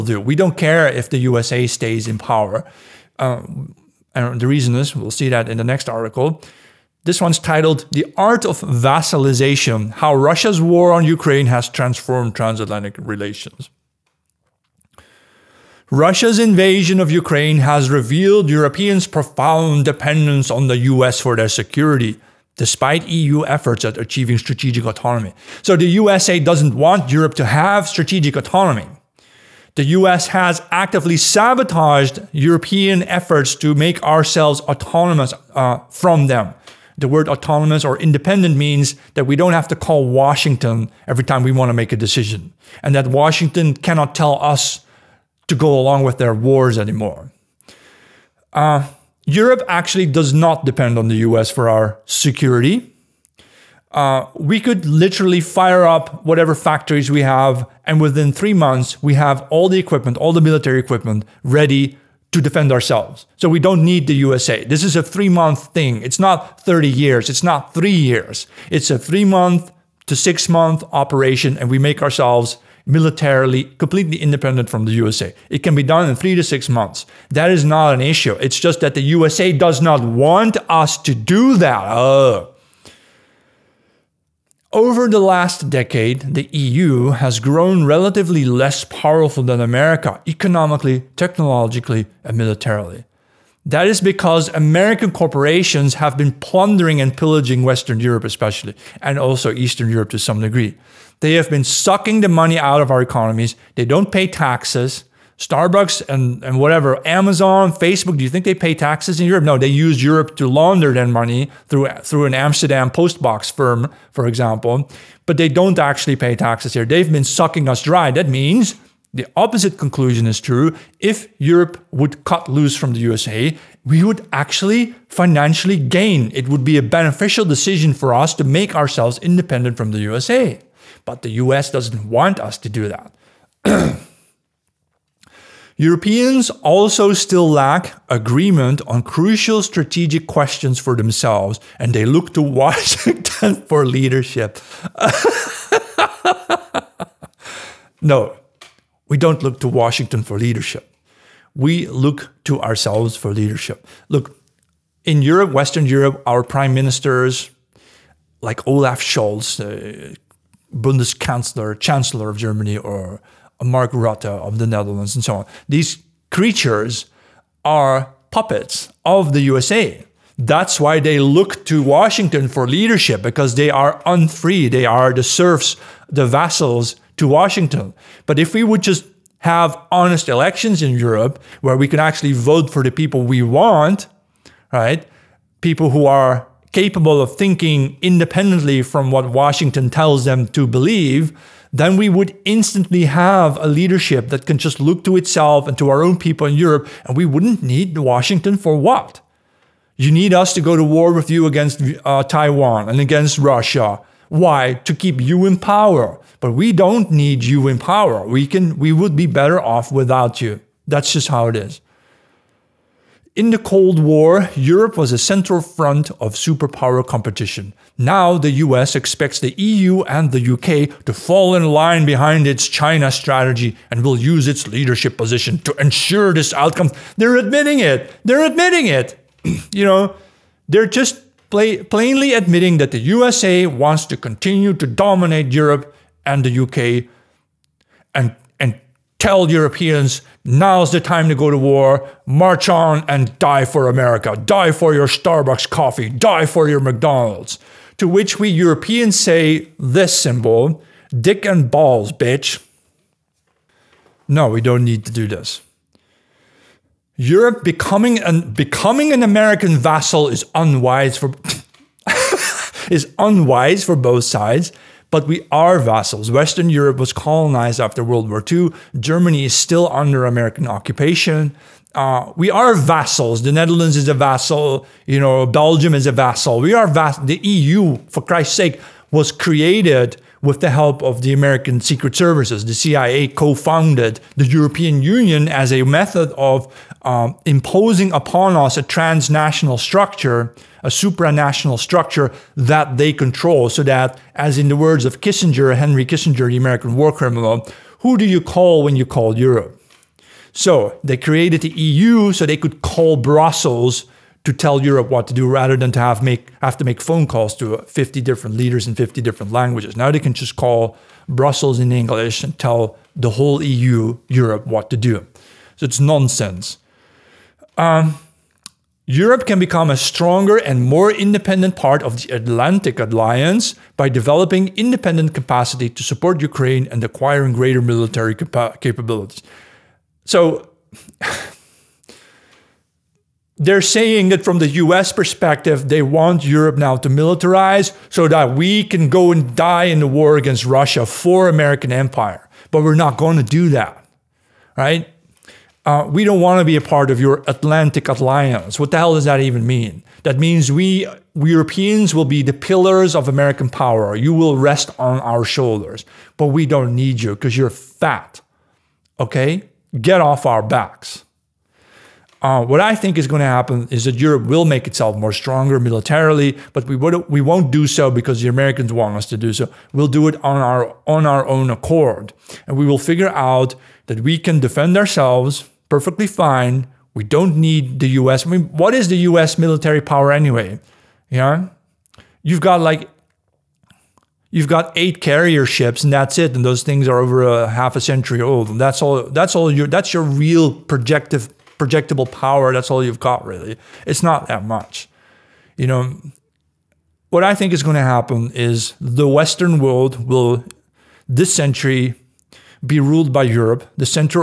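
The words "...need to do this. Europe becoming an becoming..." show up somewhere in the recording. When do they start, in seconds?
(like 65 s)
254 s.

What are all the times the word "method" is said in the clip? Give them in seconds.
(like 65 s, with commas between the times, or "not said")
285 s.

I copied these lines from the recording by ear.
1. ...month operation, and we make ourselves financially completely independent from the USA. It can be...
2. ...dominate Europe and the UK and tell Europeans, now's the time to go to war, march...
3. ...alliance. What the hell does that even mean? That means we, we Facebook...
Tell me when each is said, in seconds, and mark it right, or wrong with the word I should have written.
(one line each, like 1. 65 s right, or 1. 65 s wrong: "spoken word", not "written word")
1. 70 s wrong: "militarily", not "financially"
2. 234 s right
3. 348 s wrong: "Europeans", not "Facebook".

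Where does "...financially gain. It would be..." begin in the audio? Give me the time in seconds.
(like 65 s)
125 s.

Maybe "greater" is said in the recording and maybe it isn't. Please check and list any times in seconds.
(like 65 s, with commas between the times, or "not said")
327 s.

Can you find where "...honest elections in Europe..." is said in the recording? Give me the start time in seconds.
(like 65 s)
179 s.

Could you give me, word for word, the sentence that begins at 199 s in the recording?
You need us to go to war with you against uh, Taiwan and against Russia.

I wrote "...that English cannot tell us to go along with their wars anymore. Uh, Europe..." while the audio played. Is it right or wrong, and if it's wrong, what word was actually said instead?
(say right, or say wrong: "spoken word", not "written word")
wrong: "Washington", not "English".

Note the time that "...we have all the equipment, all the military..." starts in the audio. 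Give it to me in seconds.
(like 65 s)
59 s.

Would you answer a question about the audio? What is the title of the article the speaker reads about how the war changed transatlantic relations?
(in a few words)
The Art of Vassalization.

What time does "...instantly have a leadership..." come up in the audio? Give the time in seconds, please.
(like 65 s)
192 s.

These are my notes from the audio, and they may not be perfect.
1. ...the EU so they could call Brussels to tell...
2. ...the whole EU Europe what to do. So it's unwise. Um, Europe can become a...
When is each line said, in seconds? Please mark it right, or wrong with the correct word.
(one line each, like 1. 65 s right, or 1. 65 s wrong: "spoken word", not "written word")
1. 301 s right
2. 313 s wrong: "nonsense", not "unwise".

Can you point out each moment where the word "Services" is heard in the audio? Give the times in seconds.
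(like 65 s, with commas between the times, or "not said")
282 s.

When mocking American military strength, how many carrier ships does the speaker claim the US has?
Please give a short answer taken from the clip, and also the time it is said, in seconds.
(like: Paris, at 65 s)
8, at 384 s.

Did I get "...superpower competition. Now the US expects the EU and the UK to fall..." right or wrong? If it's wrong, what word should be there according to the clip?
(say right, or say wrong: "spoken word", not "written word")
right.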